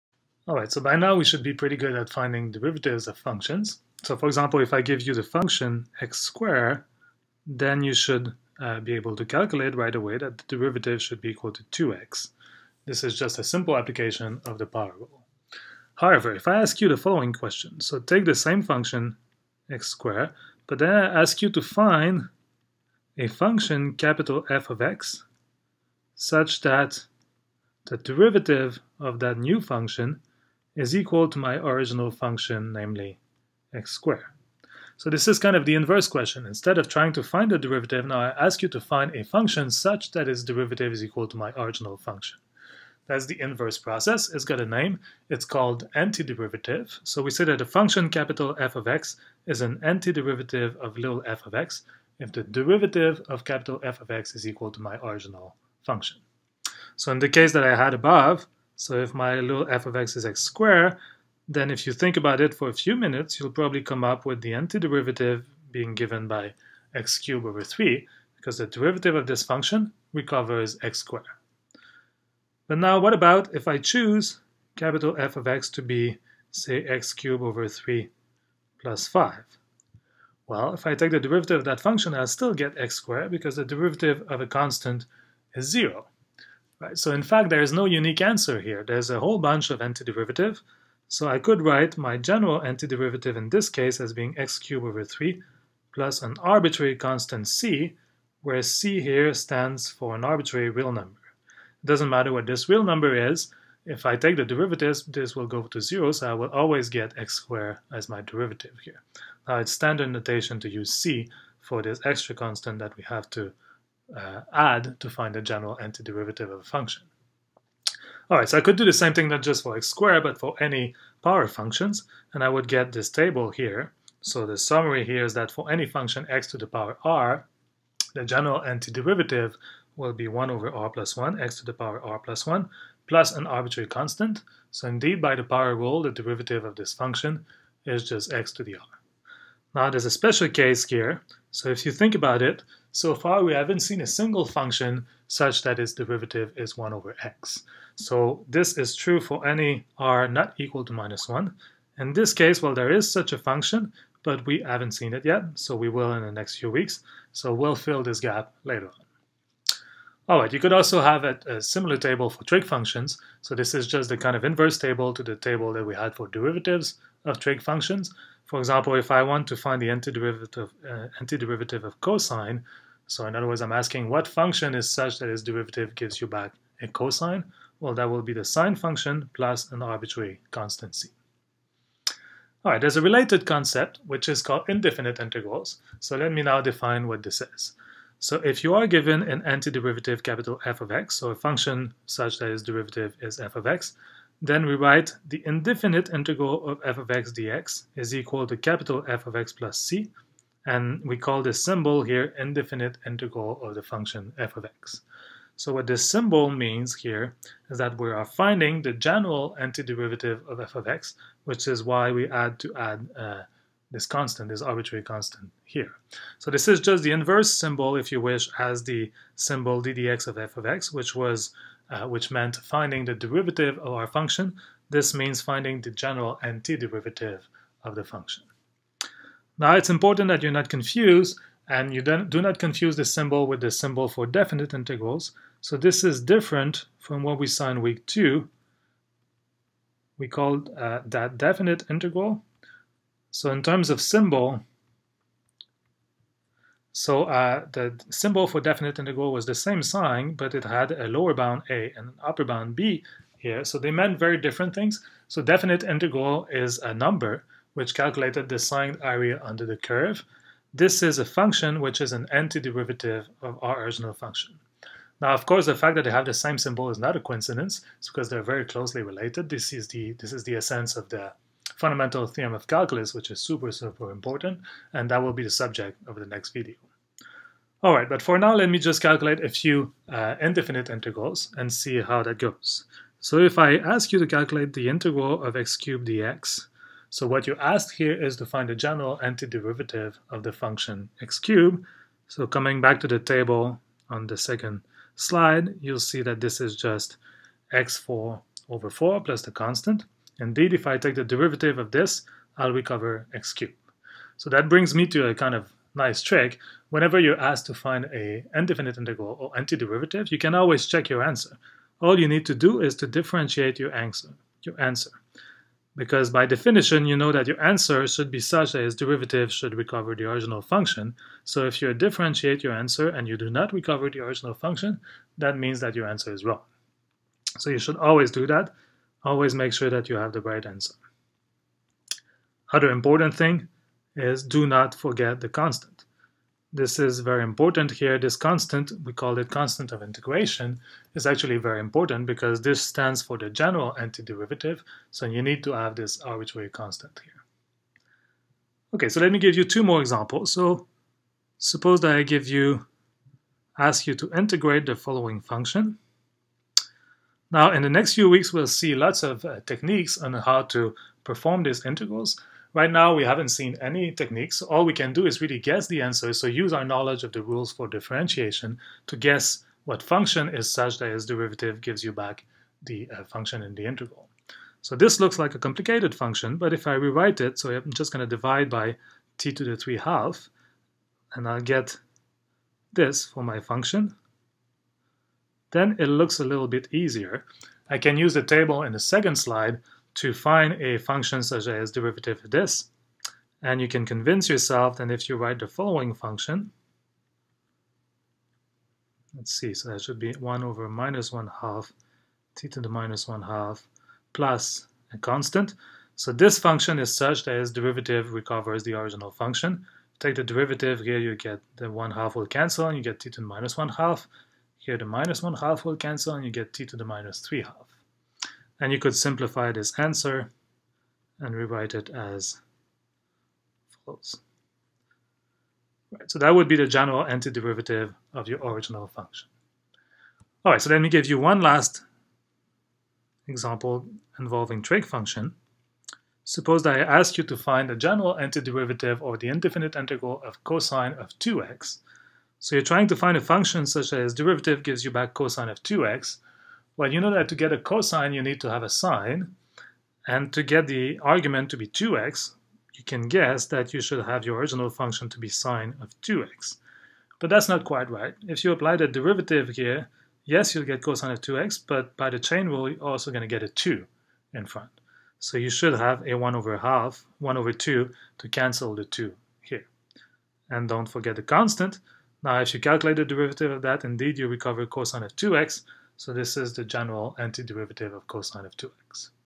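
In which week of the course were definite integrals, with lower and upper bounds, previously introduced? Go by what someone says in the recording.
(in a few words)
week two.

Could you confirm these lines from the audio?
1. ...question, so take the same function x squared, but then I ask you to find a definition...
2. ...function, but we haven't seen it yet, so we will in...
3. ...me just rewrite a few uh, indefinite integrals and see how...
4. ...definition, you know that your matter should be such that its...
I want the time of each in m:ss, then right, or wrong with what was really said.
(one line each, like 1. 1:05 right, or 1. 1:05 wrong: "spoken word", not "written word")
1. 0:17 wrong: "function", not "definition"
2. 2:33 right
3. 4:38 wrong: "calculate", not "rewrite"
4. 5:16 wrong: "answer", not "matter".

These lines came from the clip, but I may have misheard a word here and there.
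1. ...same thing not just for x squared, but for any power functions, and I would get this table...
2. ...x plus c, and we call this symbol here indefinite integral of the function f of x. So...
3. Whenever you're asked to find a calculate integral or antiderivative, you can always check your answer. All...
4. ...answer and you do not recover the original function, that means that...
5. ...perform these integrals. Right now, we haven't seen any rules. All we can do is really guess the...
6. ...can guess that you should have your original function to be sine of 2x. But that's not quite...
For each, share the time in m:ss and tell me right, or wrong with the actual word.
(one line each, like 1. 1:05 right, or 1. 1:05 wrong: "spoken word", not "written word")
1. 1:58 right
2. 3:19 right
3. 5:06 wrong: "indefinite", not "calculate"
4. 5:22 right
5. 6:01 wrong: "techniques", not "rules"
6. 7:33 right.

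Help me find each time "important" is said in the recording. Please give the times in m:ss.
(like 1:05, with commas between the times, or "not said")
3:49, 4:34, 5:32, 5:37, 5:41.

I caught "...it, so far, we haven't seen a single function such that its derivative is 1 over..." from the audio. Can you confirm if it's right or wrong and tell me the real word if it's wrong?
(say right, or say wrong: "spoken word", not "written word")
right.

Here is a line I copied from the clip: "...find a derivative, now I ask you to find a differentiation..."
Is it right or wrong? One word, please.
wrong.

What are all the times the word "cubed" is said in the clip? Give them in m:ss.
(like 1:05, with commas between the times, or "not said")
1:07, 1:17, 1:34, 4:45, 4:51, 5:03.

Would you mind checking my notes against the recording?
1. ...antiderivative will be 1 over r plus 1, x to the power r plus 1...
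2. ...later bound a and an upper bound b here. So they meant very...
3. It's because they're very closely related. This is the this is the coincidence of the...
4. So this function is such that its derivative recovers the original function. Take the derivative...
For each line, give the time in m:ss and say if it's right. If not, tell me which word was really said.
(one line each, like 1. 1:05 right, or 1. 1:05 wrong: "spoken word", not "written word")
1. 2:08 right
2. 4:11 wrong: "lower", not "later"
3. 4:27 wrong: "essence", not "coincidence"
4. 6:46 right.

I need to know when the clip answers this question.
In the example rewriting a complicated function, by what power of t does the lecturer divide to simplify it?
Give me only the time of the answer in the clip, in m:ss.
6:19.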